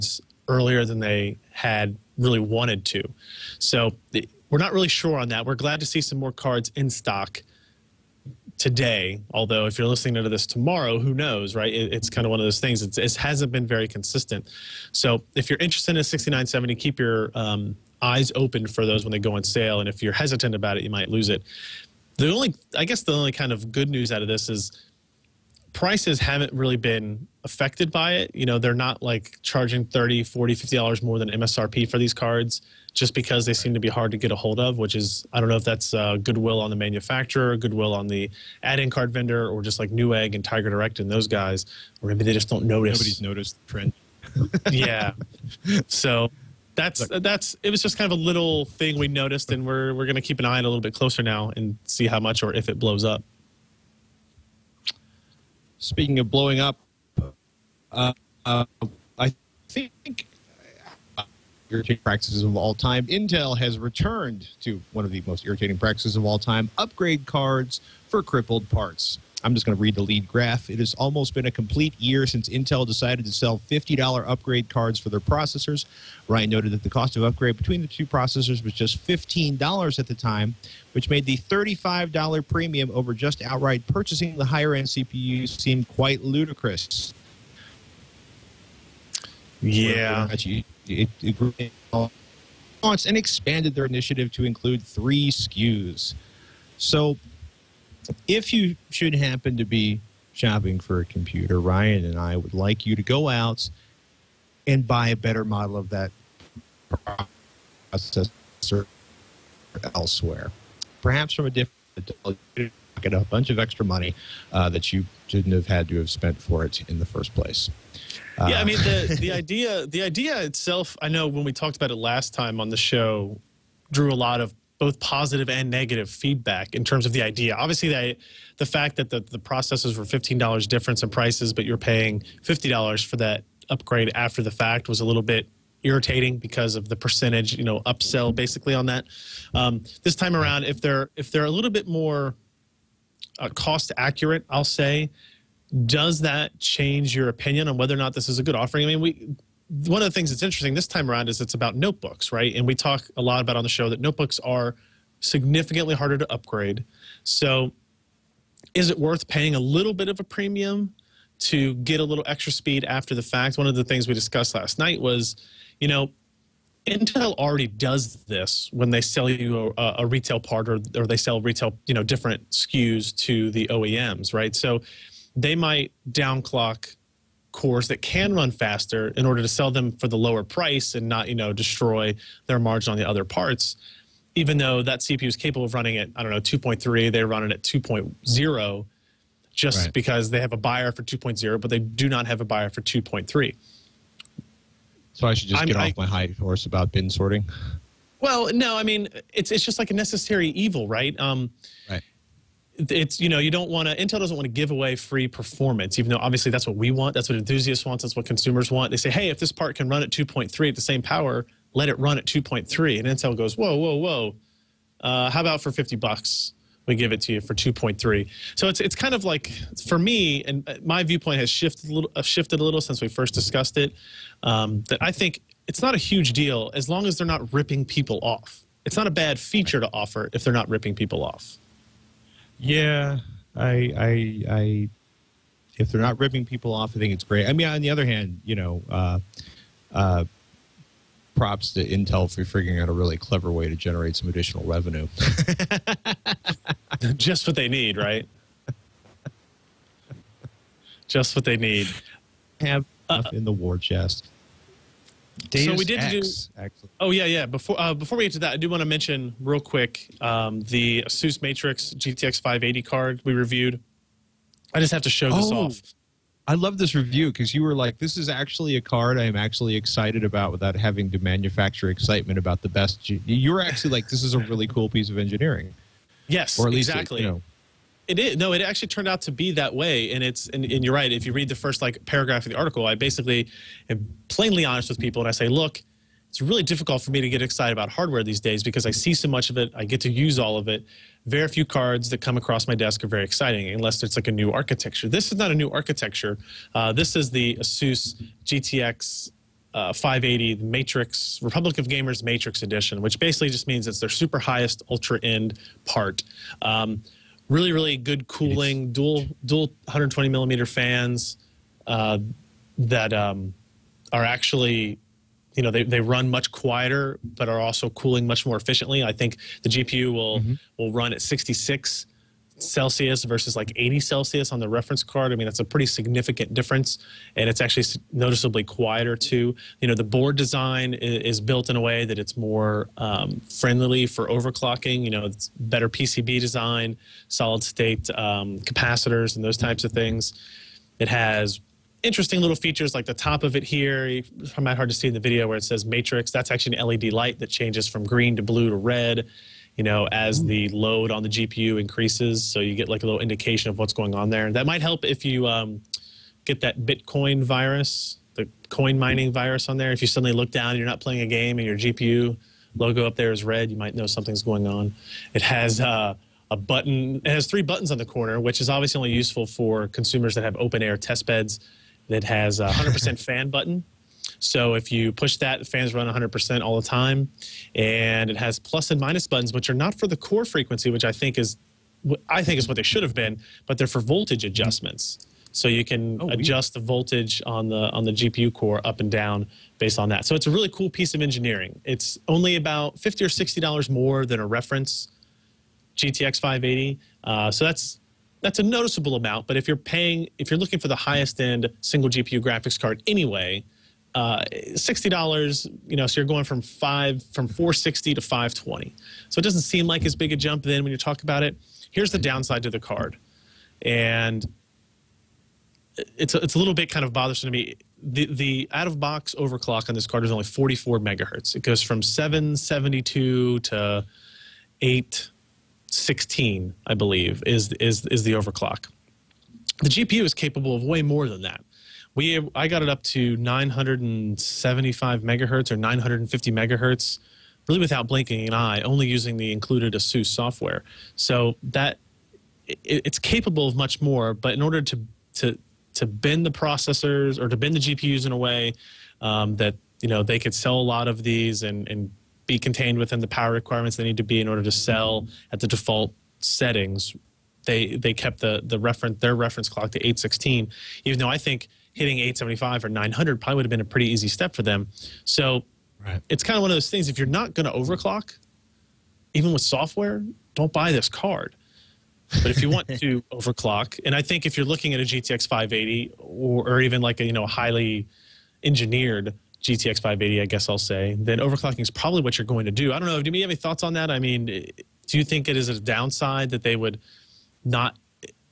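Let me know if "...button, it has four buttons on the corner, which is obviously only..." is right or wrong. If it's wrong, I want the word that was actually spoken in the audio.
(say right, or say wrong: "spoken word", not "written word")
wrong: "three", not "four".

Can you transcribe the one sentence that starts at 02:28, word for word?
I mean, we one of the things that's interesting this time around is it's about notebooks, right?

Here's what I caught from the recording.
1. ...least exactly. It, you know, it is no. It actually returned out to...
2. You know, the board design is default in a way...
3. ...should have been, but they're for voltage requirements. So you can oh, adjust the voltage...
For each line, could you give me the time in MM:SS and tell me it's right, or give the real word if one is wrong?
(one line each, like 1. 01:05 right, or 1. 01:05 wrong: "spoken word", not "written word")
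1. 04:36 wrong: "turned", not "returned"
2. 05:29 wrong: "built", not "default"
3. 06:22 wrong: "adjustments", not "requirements".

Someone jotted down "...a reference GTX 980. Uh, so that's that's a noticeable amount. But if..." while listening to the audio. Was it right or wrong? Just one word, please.
wrong.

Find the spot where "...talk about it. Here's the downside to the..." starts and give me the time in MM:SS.
06:50.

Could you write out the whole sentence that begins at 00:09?
Although, if you're listening to this tomorrow, who knows, right?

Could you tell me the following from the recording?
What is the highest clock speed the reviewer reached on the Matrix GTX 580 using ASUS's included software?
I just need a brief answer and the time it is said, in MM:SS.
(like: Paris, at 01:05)
975 MHz, at 07:13.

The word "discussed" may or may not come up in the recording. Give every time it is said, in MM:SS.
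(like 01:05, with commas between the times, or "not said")
02:44, 03:43.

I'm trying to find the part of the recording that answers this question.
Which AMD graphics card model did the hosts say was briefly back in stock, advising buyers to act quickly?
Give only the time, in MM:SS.
00:16.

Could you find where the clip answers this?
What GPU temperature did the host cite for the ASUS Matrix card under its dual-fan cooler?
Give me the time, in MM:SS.
05:21.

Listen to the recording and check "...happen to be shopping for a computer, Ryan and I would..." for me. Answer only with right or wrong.
right.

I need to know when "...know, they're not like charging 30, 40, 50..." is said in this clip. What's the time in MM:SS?
00:28.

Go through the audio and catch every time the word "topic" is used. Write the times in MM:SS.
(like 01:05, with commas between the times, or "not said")
not said.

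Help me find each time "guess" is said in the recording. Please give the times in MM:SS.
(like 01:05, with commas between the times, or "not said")
00:22, 08:00.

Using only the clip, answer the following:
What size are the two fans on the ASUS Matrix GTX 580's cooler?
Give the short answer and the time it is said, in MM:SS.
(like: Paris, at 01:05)
120 millimeter, at 05:09.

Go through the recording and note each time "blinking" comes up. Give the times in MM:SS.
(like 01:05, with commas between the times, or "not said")
07:18.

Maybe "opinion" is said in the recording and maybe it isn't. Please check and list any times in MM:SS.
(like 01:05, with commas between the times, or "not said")
02:27.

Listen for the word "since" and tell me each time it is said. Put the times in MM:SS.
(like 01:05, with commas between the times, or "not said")
01:12, 03:42.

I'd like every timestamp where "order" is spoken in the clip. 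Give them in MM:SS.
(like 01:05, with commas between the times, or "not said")
02:59, 07:24, 07:34.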